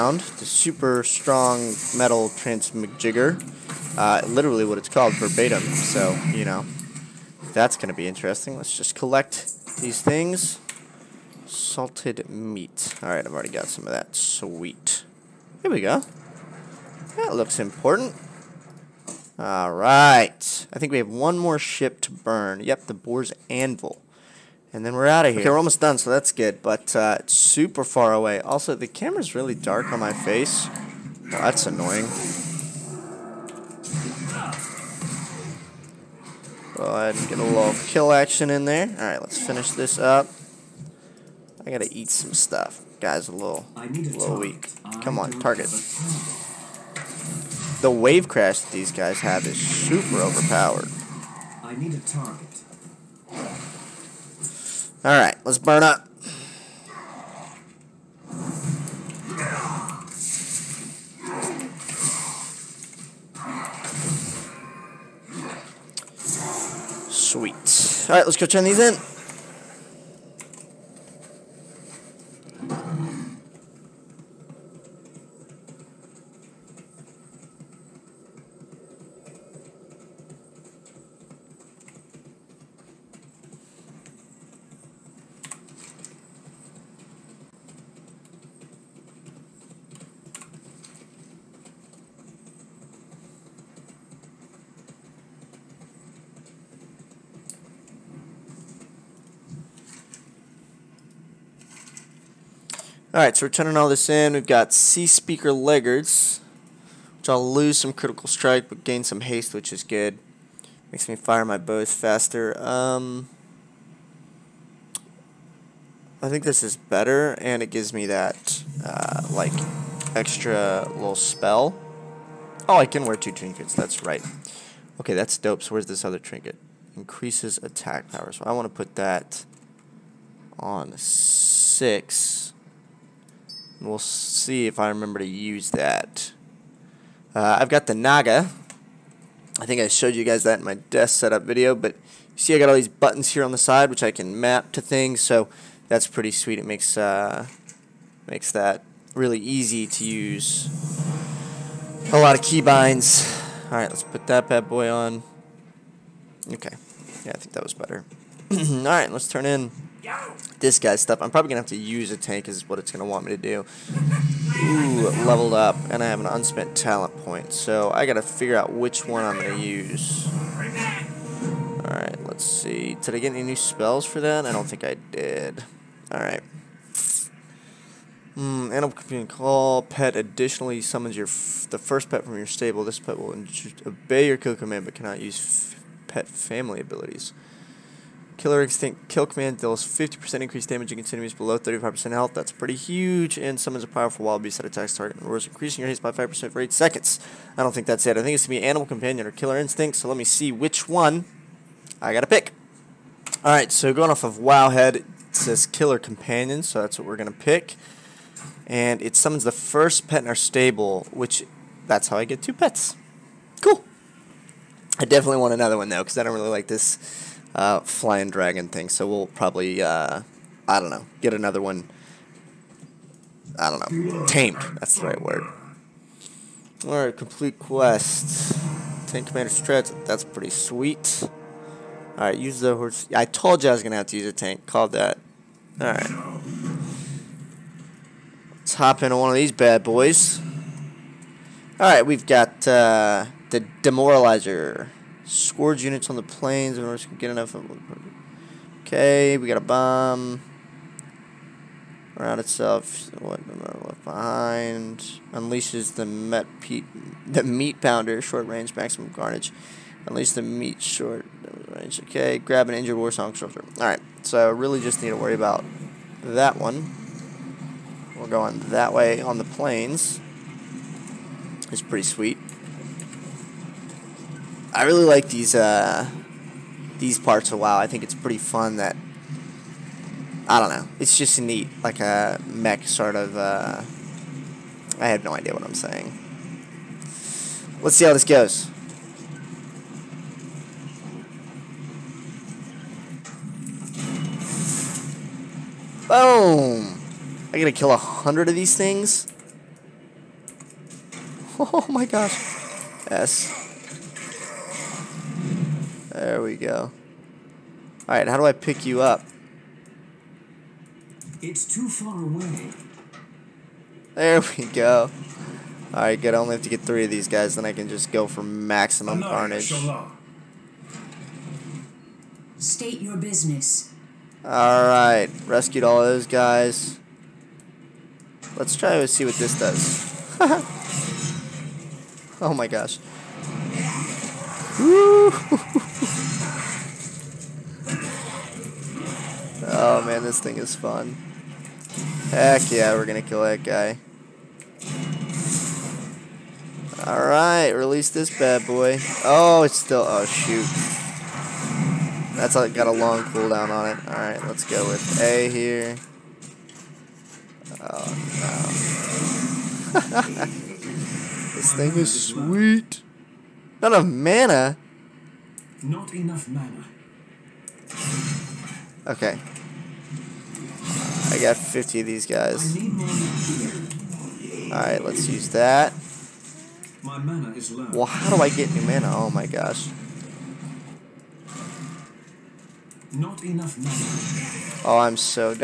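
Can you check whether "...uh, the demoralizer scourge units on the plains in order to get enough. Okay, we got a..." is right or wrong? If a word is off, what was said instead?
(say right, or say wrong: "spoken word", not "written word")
right.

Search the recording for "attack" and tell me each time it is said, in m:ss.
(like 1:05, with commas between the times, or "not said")
2:07, 3:14.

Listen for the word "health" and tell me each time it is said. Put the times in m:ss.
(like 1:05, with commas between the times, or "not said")
3:12.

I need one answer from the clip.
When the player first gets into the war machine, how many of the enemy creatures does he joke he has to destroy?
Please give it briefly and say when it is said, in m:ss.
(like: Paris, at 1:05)
100, at 4:57.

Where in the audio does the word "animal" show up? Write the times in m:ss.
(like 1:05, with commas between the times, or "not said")
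2:58, 3:18.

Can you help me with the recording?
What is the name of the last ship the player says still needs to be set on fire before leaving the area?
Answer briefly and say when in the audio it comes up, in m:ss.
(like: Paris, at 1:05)
The Boar's Anvil, at 0:22.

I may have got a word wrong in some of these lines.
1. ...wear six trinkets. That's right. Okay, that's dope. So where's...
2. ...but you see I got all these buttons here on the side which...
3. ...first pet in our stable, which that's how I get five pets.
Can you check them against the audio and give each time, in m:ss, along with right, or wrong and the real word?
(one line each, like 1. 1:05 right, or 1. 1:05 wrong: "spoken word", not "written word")
1. 2:03 wrong: "two", not "six"
2. 2:21 right
3. 3:29 wrong: "two", not "five".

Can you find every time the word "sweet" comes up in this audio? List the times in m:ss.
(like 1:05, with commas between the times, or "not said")
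0:14, 1:07, 2:26, 3:50, 4:32, 6:02.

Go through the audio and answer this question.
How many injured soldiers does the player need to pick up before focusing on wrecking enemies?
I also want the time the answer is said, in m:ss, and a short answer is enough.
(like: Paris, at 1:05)
3, at 5:16.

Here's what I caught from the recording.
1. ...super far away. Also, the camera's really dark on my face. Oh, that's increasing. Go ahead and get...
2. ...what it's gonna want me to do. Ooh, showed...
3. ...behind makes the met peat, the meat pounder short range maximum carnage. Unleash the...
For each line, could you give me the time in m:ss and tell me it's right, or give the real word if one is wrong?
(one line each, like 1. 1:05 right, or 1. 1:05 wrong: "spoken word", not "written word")
1. 0:27 wrong: "annoying", not "increasing"
2. 2:42 wrong: "leveled", not "showed"
3. 4:14 wrong: "unleashes", not "makes".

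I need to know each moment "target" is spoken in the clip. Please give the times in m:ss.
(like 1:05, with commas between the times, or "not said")
0:45, 0:51, 3:14.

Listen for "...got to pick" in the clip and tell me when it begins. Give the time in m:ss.
3:22.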